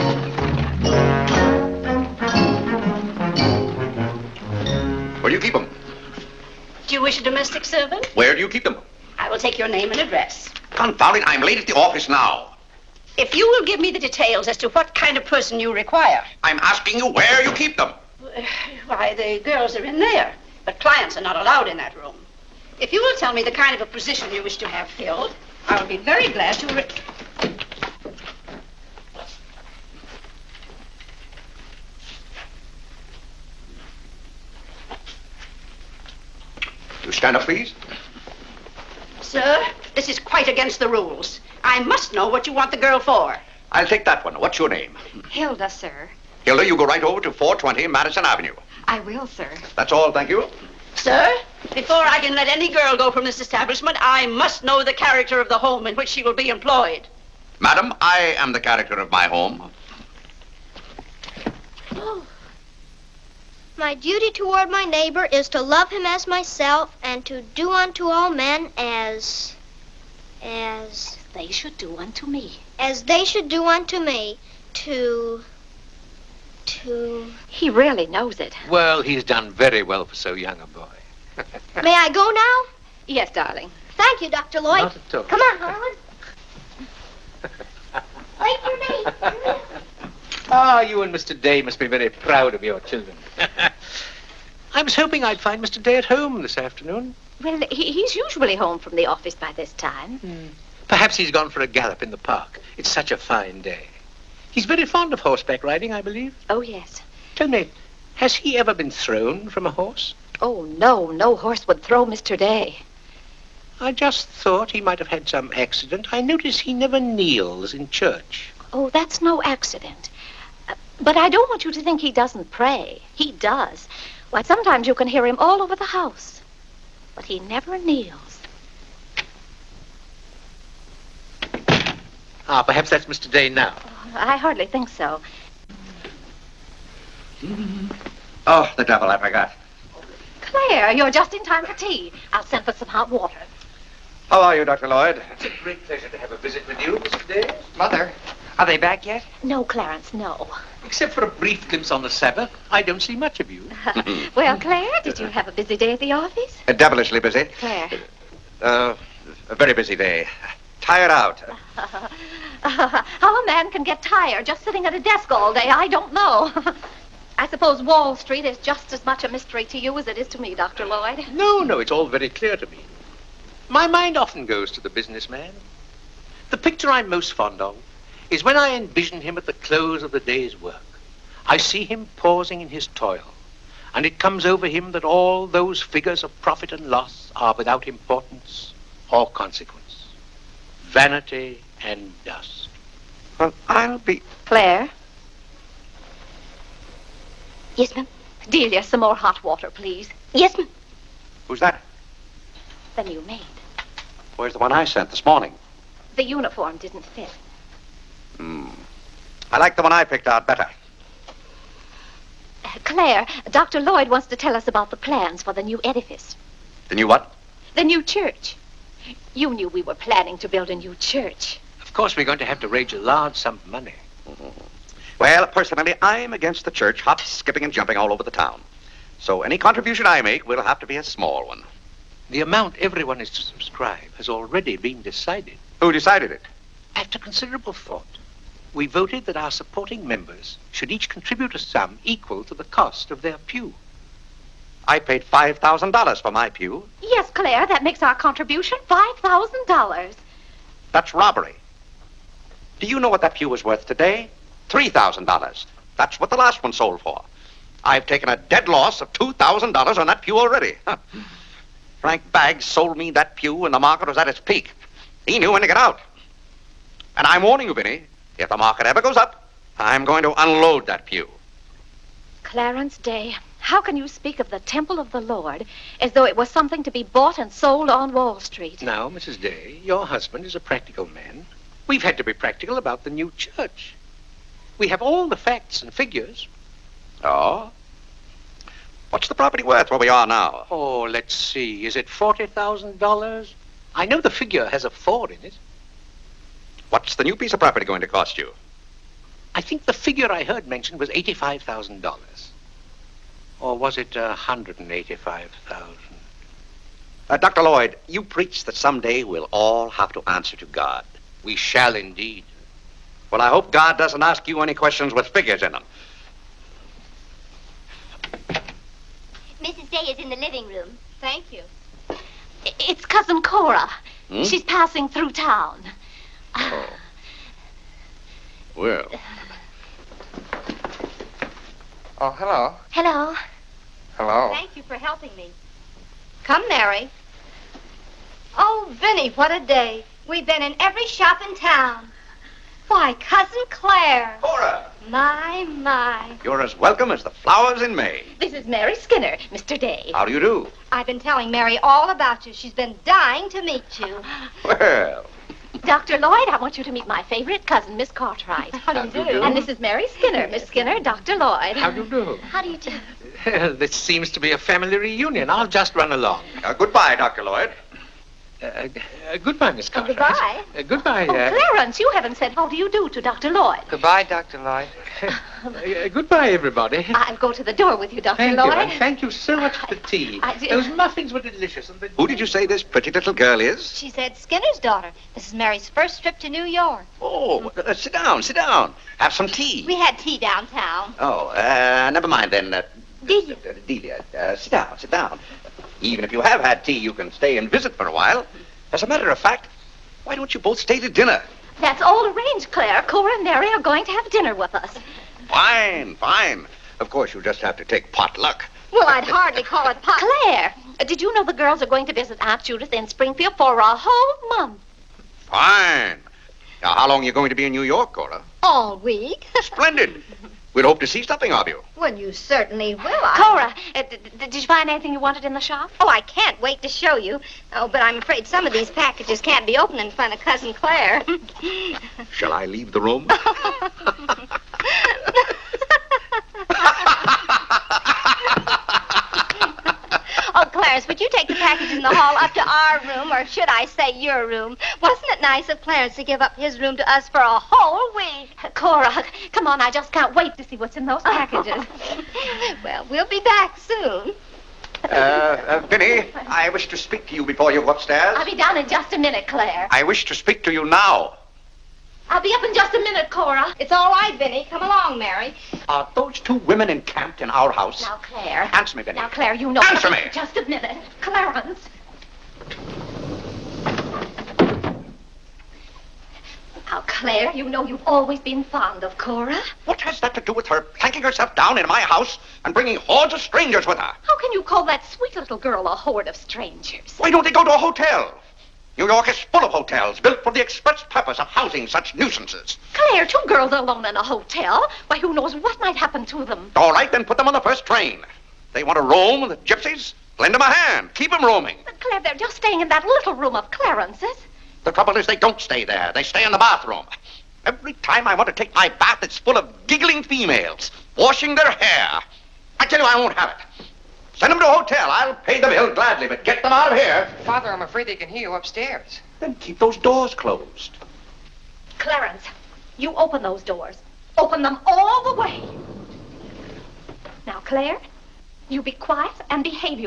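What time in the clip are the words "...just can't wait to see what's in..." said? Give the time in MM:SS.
07:29.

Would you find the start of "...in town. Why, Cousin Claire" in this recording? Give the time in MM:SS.
05:41.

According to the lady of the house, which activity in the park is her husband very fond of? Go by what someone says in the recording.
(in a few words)
Horseback riding.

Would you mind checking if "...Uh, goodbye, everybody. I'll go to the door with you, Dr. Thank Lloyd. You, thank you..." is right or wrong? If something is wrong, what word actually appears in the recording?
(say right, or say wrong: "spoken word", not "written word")
right.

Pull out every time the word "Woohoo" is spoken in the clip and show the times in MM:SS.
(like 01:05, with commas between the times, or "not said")
not said.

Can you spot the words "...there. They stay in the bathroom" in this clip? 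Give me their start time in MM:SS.
08:25.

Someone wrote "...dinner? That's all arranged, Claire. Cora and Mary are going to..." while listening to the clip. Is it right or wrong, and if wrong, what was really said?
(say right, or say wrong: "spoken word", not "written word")
right.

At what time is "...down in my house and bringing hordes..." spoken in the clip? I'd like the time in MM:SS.
08:01.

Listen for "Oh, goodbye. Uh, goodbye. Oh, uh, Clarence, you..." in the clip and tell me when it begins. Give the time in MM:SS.
06:10.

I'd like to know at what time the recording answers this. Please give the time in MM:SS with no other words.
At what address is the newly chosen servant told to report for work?
00:47.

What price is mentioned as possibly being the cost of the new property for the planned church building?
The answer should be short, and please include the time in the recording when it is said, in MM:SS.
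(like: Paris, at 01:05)
$85,000, at 05:01.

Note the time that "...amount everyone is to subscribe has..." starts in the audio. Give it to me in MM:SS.
03:52.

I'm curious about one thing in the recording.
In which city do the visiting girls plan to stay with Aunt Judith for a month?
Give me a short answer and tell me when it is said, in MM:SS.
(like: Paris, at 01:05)
Springfield, at 06:53.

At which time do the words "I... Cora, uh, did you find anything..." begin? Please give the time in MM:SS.
07:03.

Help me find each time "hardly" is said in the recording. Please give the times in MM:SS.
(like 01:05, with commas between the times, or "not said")
02:14, 06:49.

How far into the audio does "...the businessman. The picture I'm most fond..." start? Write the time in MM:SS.
02:54.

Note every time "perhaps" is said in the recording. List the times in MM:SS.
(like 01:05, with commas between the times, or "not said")
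01:40, 02:12.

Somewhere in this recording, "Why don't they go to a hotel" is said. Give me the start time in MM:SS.
08:07.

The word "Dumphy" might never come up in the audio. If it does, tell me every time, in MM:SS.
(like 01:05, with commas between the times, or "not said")
not said.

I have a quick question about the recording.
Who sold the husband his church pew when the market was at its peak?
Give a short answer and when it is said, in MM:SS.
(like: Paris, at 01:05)
Frank Baggs, at 04:22.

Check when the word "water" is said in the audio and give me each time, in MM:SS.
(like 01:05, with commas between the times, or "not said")
02:23, 03:19.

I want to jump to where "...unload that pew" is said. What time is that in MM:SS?
04:30.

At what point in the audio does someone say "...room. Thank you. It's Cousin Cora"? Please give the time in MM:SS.
05:20.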